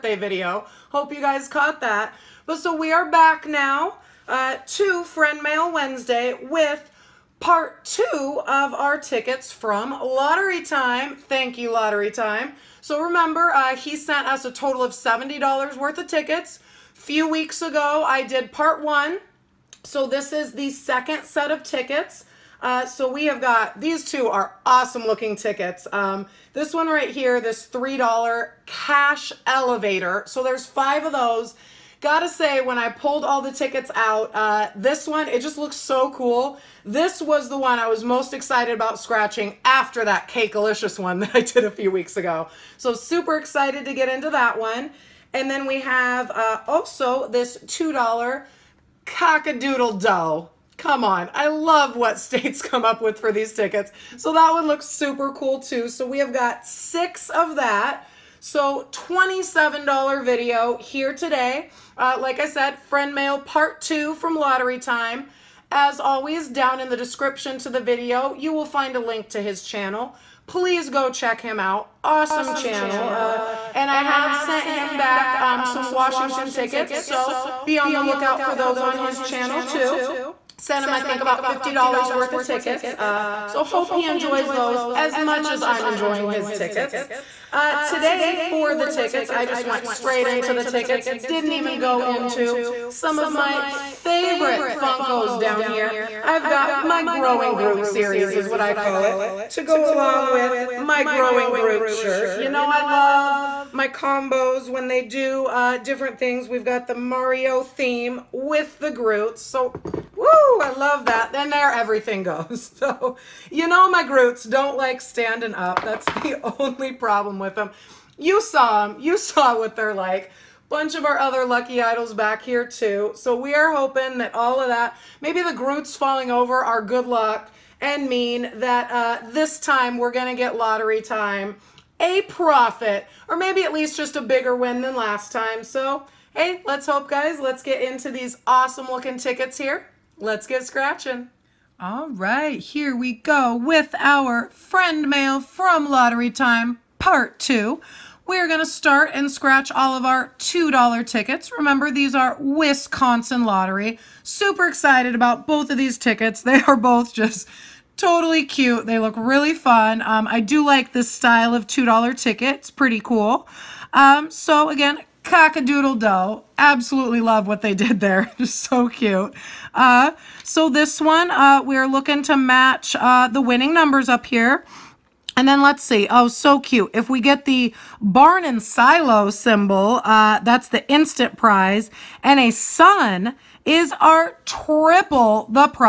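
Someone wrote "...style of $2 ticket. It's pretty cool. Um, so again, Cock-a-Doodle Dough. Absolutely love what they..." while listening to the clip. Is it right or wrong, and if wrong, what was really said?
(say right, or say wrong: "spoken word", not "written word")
right.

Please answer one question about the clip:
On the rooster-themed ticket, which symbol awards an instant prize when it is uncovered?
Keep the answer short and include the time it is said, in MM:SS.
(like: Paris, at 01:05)
barn and silo, at 02:58.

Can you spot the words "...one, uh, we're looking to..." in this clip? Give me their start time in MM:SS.
02:50.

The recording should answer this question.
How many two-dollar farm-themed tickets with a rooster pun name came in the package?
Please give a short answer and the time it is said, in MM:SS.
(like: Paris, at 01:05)
6, at 00:56.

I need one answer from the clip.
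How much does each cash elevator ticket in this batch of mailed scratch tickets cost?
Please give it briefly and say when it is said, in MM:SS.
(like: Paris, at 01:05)
$3, at 00:27.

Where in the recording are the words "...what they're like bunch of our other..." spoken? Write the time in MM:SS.
01:59.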